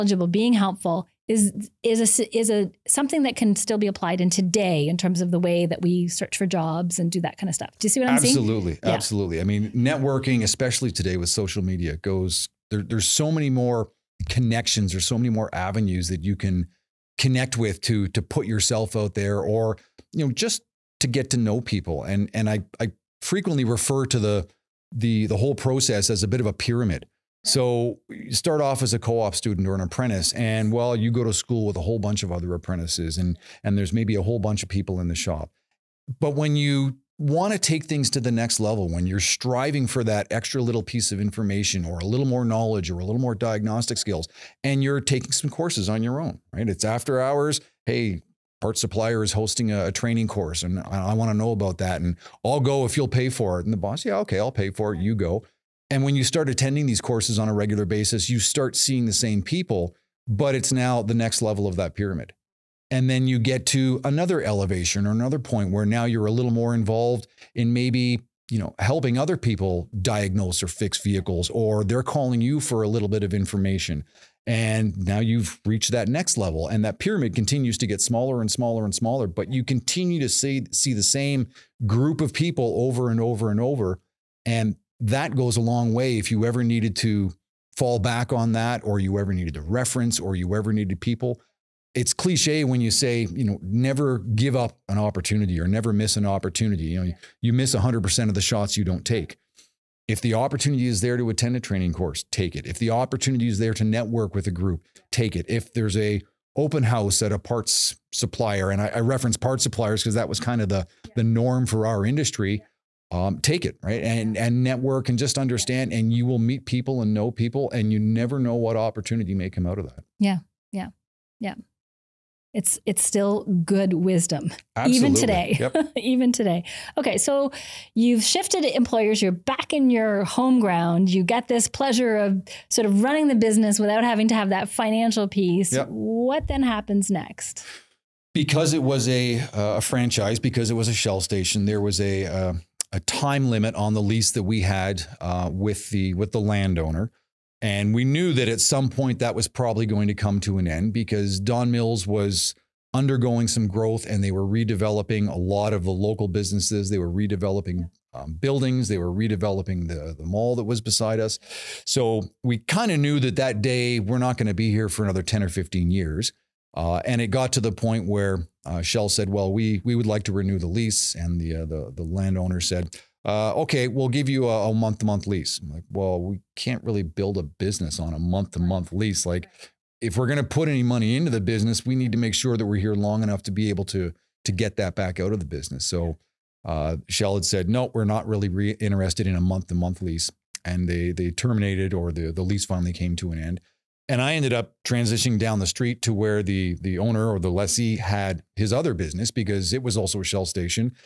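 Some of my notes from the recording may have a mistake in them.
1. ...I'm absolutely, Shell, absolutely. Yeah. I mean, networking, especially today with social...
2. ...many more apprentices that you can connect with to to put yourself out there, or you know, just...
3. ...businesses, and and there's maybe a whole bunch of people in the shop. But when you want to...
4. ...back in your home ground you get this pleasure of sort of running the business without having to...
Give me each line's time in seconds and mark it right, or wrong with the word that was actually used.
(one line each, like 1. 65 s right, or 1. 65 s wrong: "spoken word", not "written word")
1. 8 s wrong: "Absolutely", not "Shell"
2. 15 s wrong: "avenues", not "apprentices"
3. 32 s wrong: "apprentices", not "businesses"
4. 129 s right.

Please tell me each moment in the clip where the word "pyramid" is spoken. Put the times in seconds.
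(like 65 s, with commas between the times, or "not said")
26 s, 61 s, 76 s.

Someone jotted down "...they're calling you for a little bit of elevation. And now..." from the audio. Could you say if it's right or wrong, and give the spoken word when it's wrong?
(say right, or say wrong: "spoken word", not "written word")
wrong: "information", not "elevation".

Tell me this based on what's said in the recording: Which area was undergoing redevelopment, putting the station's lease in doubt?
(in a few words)
Don Mills.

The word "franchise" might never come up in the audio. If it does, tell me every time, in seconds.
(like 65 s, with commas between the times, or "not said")
139 s.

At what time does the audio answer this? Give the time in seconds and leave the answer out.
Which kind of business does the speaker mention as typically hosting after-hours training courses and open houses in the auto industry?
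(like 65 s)
48 s.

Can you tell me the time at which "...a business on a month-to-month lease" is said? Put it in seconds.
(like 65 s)
177 s.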